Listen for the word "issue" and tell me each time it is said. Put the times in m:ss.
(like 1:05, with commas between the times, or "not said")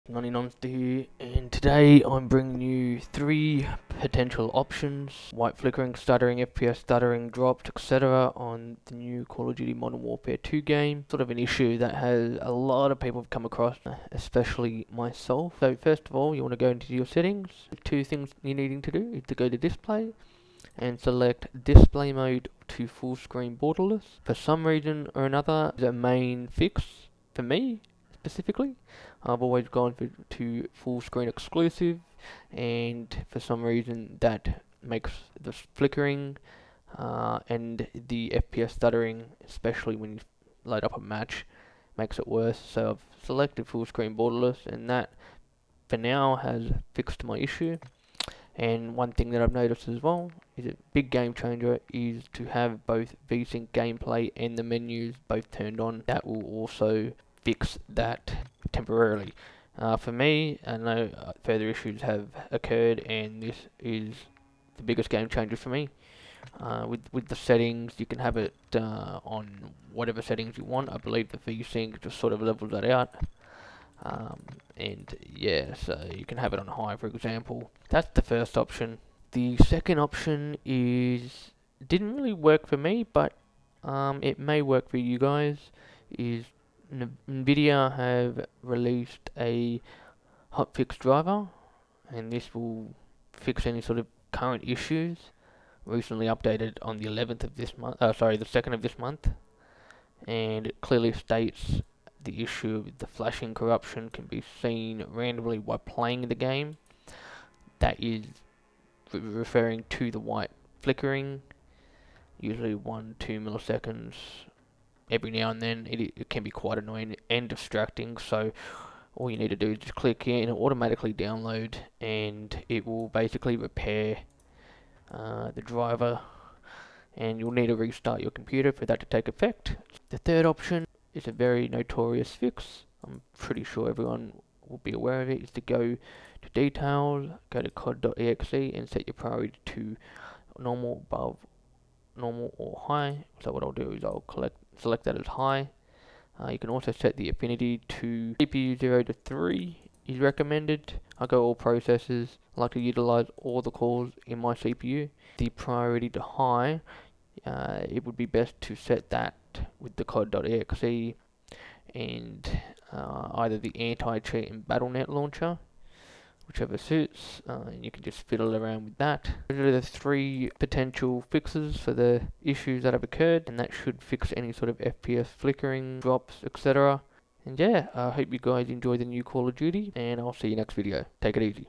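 0:11, 0:47, 1:01, 1:34, 1:42, 2:52.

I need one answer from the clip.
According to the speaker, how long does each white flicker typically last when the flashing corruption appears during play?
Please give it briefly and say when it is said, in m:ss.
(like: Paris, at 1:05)
1-2 milliseconds, at 1:52.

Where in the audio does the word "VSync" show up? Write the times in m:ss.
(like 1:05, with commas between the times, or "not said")
0:53, 1:11.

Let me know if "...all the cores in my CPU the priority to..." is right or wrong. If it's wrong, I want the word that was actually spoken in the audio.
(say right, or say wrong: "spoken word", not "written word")
right.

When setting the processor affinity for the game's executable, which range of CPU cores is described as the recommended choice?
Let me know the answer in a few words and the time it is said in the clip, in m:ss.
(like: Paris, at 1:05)
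CPU 0 to 3, at 2:28.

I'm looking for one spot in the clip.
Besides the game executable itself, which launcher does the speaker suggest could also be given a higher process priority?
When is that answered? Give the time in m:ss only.
2:44.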